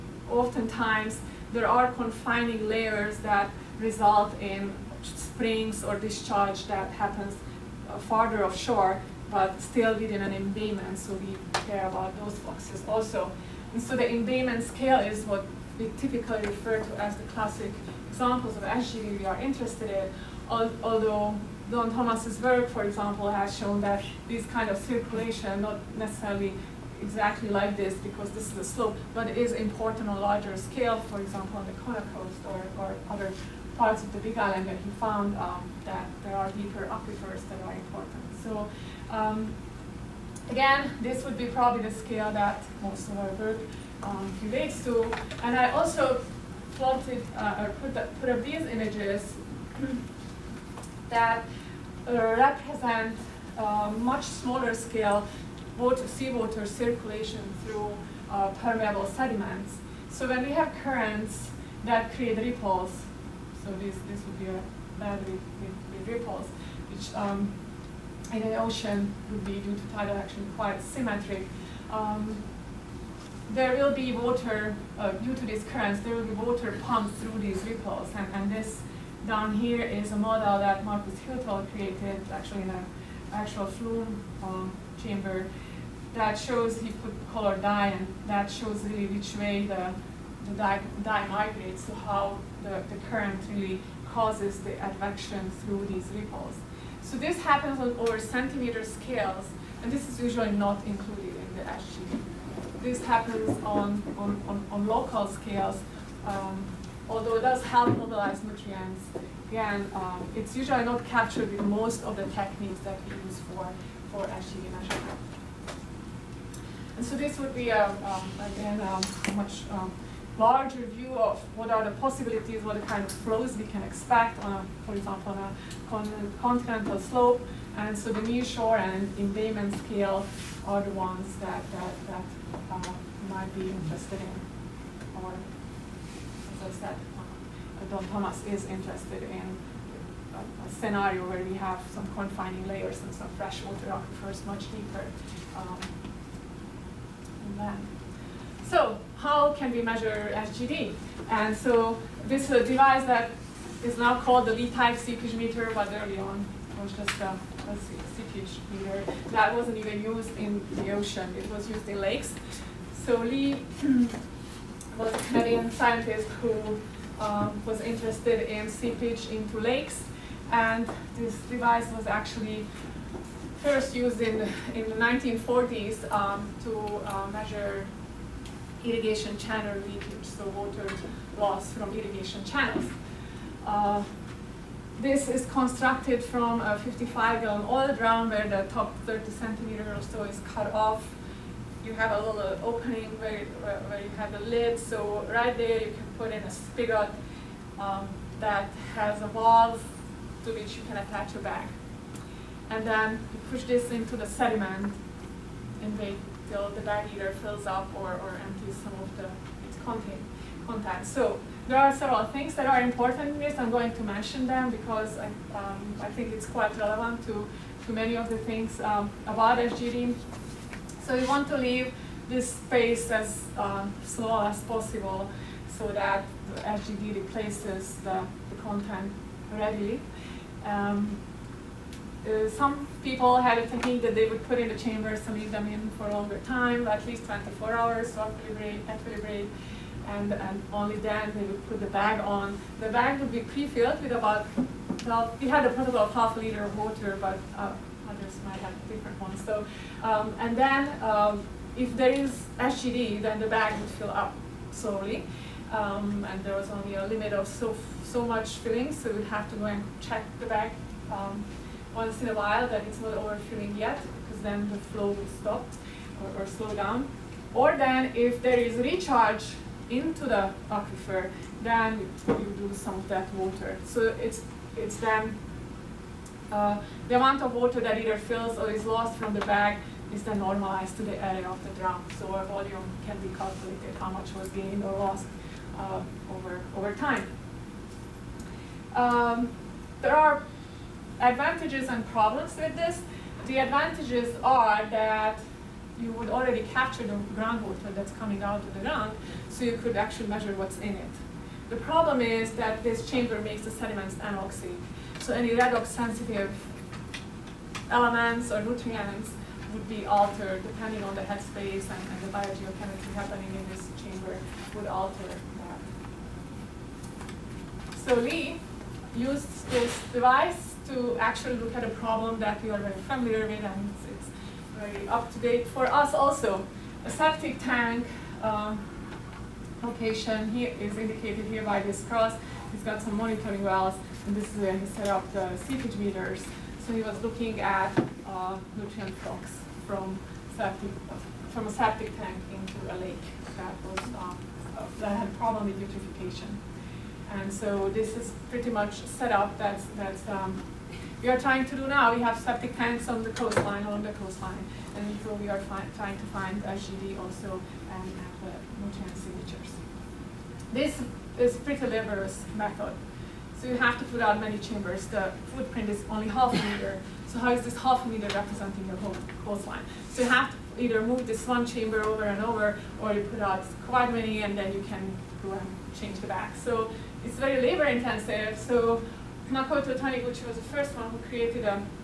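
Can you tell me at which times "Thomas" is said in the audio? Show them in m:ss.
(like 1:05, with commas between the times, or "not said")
0:21, 2:18.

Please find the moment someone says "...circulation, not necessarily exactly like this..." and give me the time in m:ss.
0:24.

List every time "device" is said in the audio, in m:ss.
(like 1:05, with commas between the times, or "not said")
2:32, 2:51, 5:20.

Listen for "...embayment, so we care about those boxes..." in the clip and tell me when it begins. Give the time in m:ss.
0:10.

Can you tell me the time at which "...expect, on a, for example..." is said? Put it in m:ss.
2:03.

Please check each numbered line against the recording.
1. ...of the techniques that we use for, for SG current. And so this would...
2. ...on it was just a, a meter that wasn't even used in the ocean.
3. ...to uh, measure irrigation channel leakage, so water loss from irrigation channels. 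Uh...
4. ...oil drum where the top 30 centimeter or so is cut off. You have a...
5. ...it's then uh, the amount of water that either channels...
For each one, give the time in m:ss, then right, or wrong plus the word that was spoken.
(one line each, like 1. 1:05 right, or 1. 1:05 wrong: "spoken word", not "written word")
1. 1:52 wrong: "measurement", not "current"
2. 2:36 right
3. 2:56 right
4. 3:07 right
5. 4:34 wrong: "fills", not "channels".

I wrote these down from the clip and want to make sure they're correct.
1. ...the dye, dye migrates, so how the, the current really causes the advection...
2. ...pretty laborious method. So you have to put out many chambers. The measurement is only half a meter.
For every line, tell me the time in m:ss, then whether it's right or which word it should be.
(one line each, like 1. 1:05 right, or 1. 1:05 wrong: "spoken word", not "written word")
1. 1:30 right
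2. 6:01 wrong: "footprint", not "measurement".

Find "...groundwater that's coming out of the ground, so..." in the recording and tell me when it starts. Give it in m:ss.
4:57.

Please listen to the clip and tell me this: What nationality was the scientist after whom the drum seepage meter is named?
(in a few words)
Canadian.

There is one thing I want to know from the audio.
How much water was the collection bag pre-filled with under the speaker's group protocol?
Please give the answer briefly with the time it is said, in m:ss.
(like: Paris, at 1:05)
half a liter, at 4:06.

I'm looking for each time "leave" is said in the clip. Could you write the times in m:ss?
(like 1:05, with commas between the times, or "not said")
3:41, 3:55.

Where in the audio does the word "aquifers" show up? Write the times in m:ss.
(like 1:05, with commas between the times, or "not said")
0:36, 2:23, 4:30.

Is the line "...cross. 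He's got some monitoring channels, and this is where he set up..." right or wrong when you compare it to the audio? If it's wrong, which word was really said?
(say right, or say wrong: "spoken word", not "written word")
wrong: "wells", not "channels".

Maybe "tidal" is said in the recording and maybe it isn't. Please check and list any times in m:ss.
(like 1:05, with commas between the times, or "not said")
1:09.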